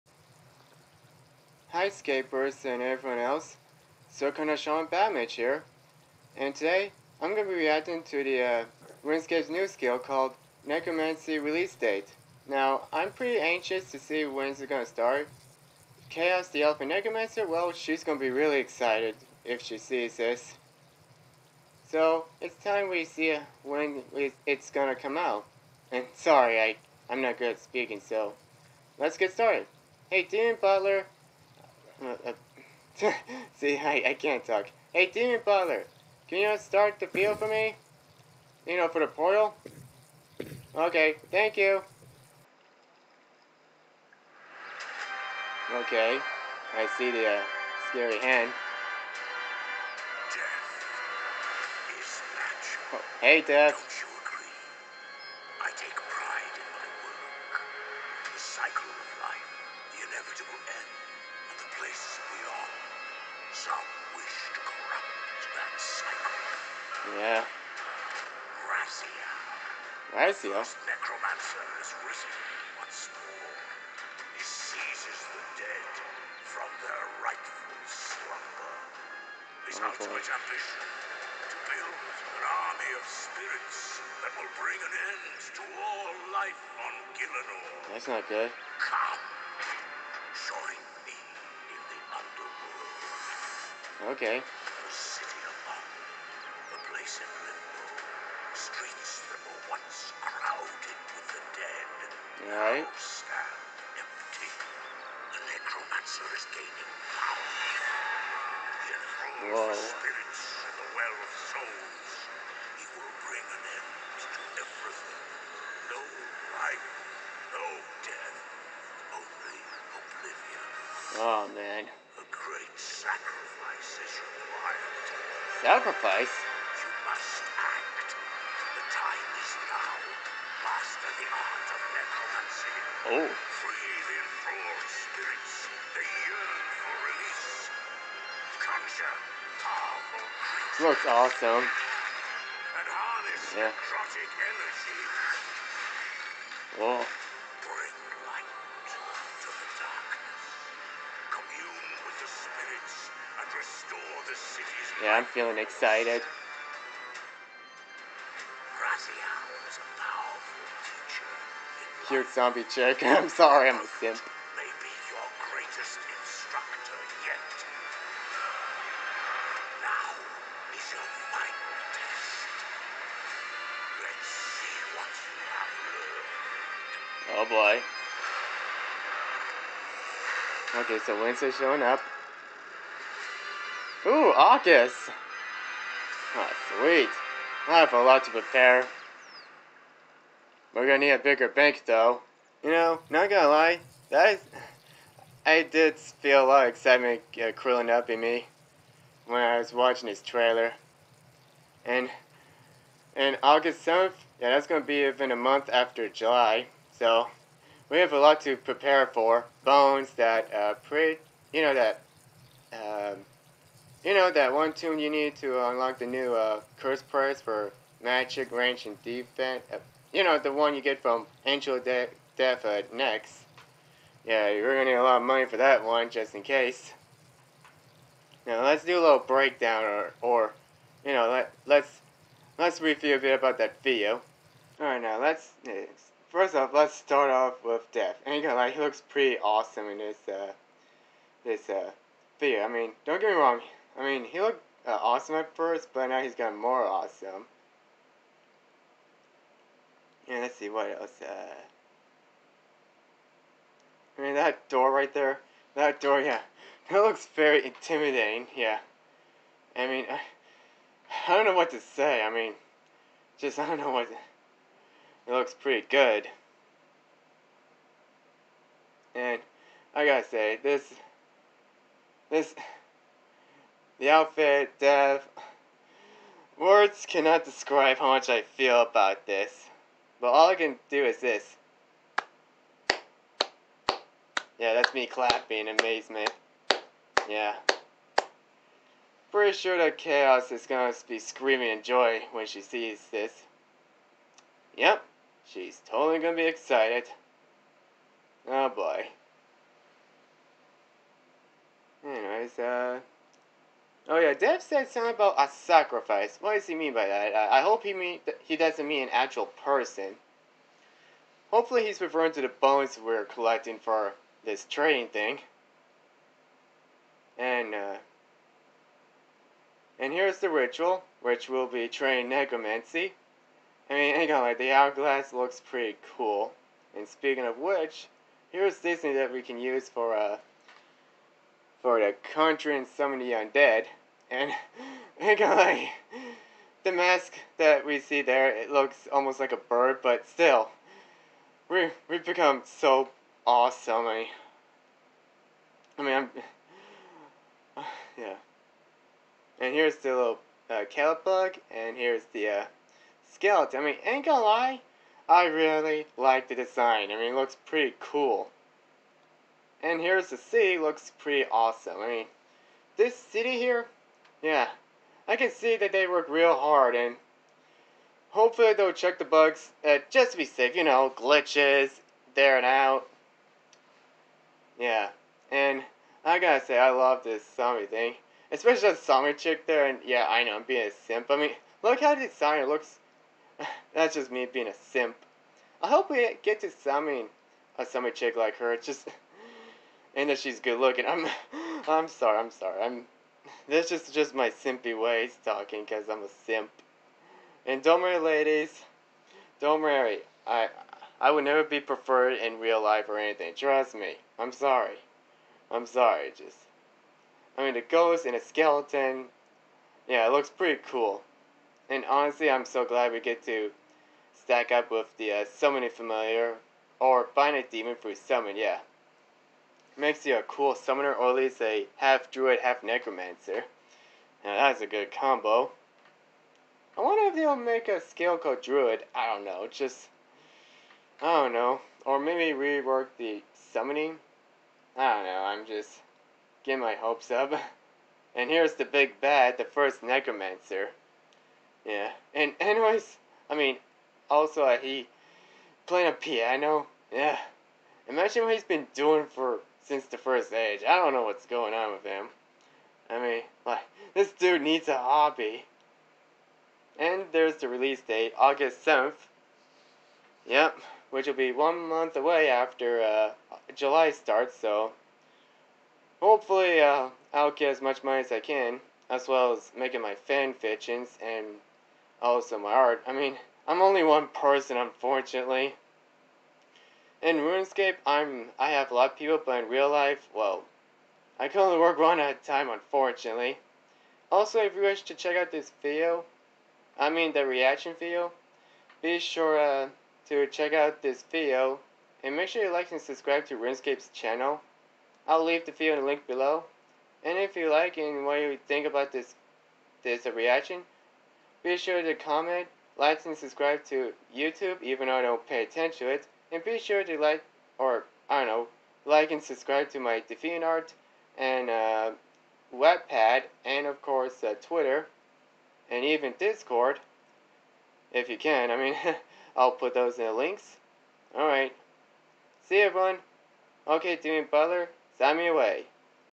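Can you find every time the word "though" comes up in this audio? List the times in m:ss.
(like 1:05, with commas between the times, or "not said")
3:11, 8:25.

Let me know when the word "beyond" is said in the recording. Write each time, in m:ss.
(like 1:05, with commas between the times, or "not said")
1:01.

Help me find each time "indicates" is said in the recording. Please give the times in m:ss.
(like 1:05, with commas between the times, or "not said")
not said.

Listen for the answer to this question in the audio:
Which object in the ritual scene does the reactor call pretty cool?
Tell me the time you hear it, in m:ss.
5:24.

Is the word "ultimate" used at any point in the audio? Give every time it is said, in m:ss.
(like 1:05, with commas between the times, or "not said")
1:19.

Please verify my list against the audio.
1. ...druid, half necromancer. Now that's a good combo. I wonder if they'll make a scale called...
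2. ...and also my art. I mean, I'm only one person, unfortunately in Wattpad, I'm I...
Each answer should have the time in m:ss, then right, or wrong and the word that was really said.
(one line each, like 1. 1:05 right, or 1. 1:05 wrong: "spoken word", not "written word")
1. 7:02 right
2. 7:51 wrong: "RuneScape", not "Wattpad".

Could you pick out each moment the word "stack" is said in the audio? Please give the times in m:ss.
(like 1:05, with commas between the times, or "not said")
6:54.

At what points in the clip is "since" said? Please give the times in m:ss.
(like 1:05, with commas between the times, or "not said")
7:29.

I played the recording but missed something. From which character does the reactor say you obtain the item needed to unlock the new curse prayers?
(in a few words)
Angel De Death.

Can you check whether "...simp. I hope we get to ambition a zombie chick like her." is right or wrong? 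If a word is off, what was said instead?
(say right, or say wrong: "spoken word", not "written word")
wrong: "summon", not "ambition".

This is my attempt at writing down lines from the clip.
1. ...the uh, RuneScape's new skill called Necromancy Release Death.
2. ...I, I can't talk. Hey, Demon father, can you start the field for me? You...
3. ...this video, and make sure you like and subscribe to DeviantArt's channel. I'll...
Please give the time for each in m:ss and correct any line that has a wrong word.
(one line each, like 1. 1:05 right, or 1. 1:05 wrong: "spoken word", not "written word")
1. 0:08 wrong: "Date", not "Death"
2. 0:33 right
3. 8:11 wrong: "RuneScape", not "DeviantArt".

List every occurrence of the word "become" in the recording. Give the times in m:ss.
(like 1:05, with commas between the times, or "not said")
5:42.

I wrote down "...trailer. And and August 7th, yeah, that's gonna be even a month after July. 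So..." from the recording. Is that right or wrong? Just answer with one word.
right.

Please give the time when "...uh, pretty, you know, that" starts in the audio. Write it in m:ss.
3:30.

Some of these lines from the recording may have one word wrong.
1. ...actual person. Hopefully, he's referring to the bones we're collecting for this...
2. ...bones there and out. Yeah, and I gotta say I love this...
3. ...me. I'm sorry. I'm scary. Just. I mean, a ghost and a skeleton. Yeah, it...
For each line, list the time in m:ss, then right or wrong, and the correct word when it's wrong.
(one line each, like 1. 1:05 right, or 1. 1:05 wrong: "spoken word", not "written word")
1. 5:09 right
2. 6:11 wrong: "glitches", not "bones"
3. 6:43 wrong: "sorry", not "scary".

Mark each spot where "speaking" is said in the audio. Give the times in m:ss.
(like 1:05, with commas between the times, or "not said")
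0:27, 5:27.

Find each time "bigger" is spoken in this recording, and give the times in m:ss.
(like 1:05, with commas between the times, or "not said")
3:11.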